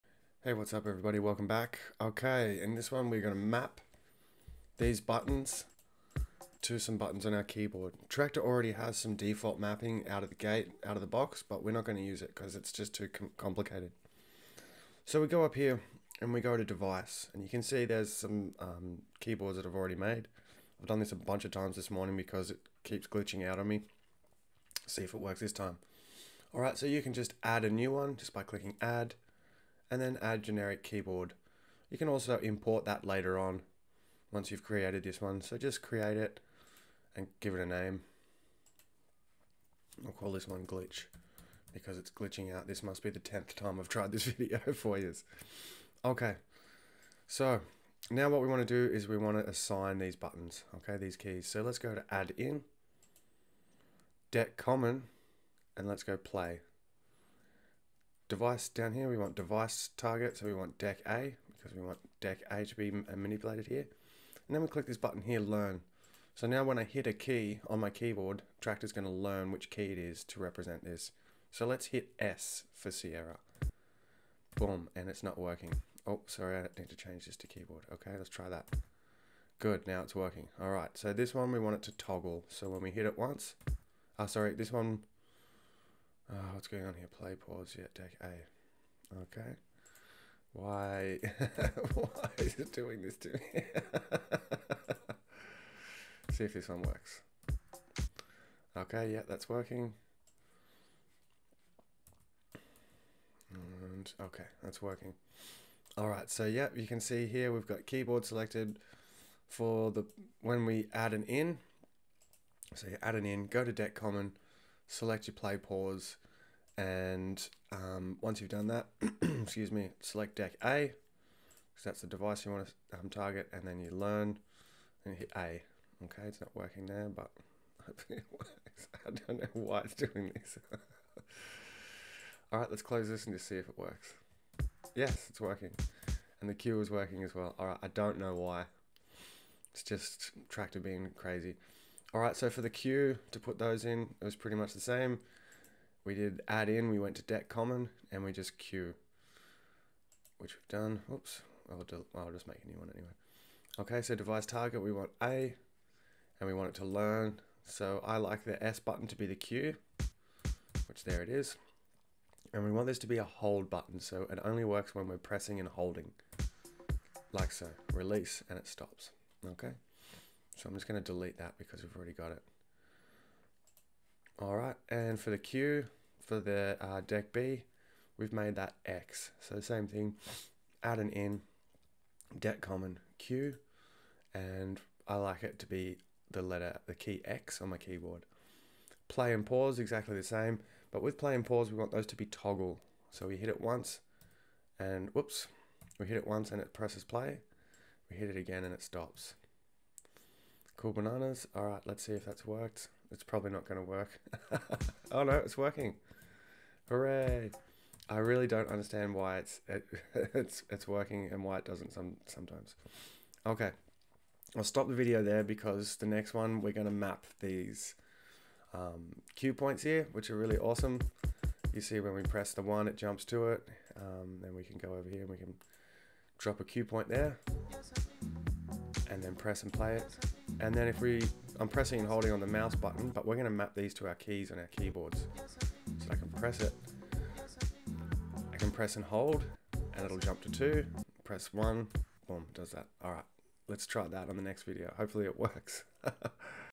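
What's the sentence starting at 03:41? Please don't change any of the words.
You see when we press the one, it jumps to it.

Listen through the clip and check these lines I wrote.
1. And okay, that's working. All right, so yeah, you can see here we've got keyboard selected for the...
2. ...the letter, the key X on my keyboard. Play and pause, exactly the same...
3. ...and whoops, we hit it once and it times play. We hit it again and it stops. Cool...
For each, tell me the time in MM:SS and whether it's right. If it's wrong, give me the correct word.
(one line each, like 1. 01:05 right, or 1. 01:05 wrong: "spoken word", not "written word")
1. 01:43 right
2. 03:06 right
3. 03:14 wrong: "presses", not "times".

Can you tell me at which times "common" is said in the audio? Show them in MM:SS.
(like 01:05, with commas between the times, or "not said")
00:54, 01:53, 02:27, 03:02.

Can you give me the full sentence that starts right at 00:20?
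I've done this a bunch of times this morning because it keeps glitching out on me.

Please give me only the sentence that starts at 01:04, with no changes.
And then we click this button here, learn.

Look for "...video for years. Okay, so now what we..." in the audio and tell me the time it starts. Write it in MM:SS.
00:44.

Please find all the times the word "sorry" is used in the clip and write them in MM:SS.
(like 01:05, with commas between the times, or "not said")
01:16, 01:24.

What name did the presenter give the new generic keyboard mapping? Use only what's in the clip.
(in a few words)
glitch.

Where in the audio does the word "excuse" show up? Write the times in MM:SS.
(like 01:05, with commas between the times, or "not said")
01:59.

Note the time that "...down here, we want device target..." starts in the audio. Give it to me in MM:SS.
00:58.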